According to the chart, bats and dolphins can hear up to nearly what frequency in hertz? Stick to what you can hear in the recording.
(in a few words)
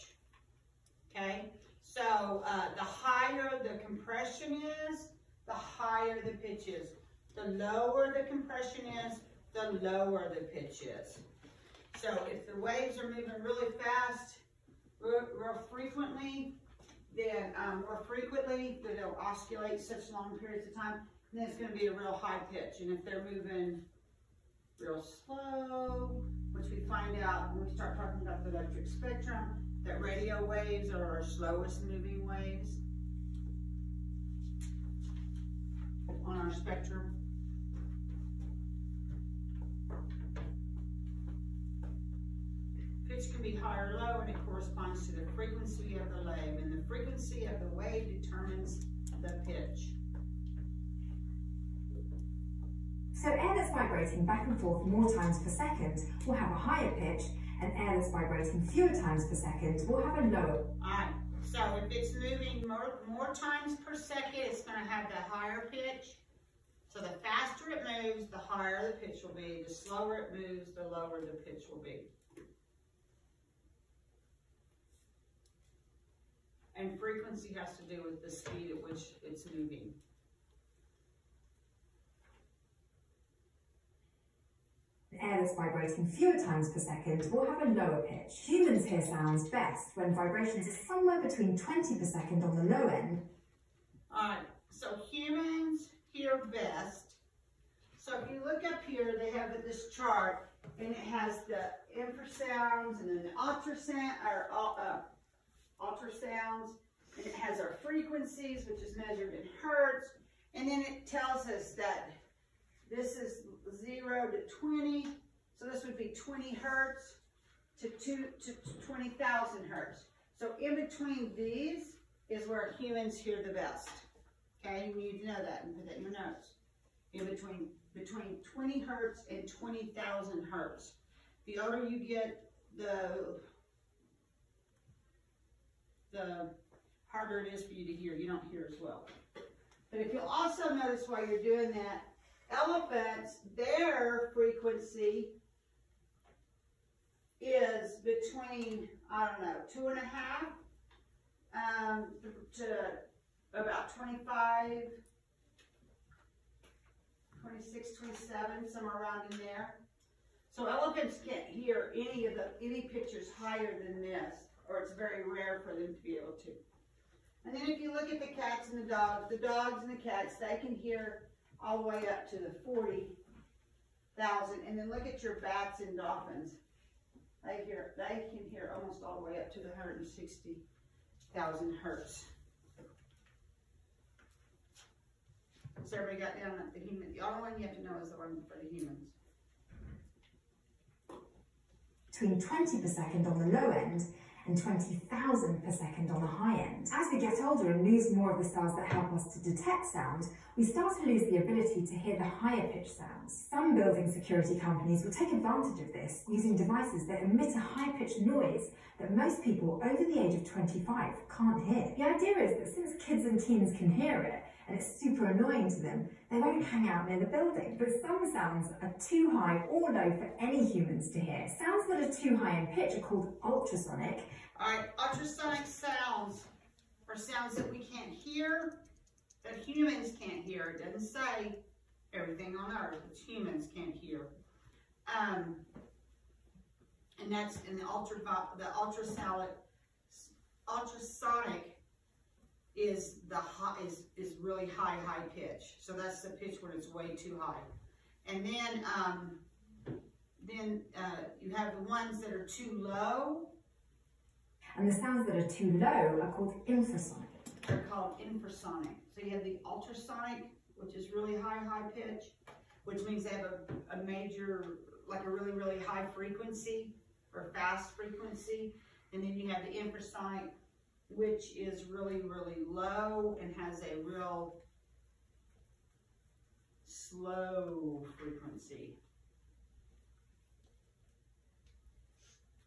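160,000 hertz.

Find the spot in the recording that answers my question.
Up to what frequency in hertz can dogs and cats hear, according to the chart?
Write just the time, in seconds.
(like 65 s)
172 s.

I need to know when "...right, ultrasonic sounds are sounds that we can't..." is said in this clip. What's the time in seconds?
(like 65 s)
224 s.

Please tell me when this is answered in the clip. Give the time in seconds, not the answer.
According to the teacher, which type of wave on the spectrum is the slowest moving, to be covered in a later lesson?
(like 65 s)
29 s.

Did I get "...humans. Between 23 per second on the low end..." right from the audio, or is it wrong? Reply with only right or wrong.
wrong.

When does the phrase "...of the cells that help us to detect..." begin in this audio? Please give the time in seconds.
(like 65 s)
198 s.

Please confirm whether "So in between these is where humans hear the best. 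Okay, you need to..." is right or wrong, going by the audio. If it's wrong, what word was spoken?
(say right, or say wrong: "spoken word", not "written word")
right.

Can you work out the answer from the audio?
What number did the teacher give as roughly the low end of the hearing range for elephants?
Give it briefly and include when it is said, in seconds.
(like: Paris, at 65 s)
2.5, at 149 s.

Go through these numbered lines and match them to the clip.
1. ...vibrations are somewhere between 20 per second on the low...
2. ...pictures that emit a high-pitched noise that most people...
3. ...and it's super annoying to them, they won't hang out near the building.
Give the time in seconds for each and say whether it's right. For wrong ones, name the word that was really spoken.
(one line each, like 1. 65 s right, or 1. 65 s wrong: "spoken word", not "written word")
1. 90 s right
2. 206 s wrong: "devices", not "pictures"
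3. 214 s right.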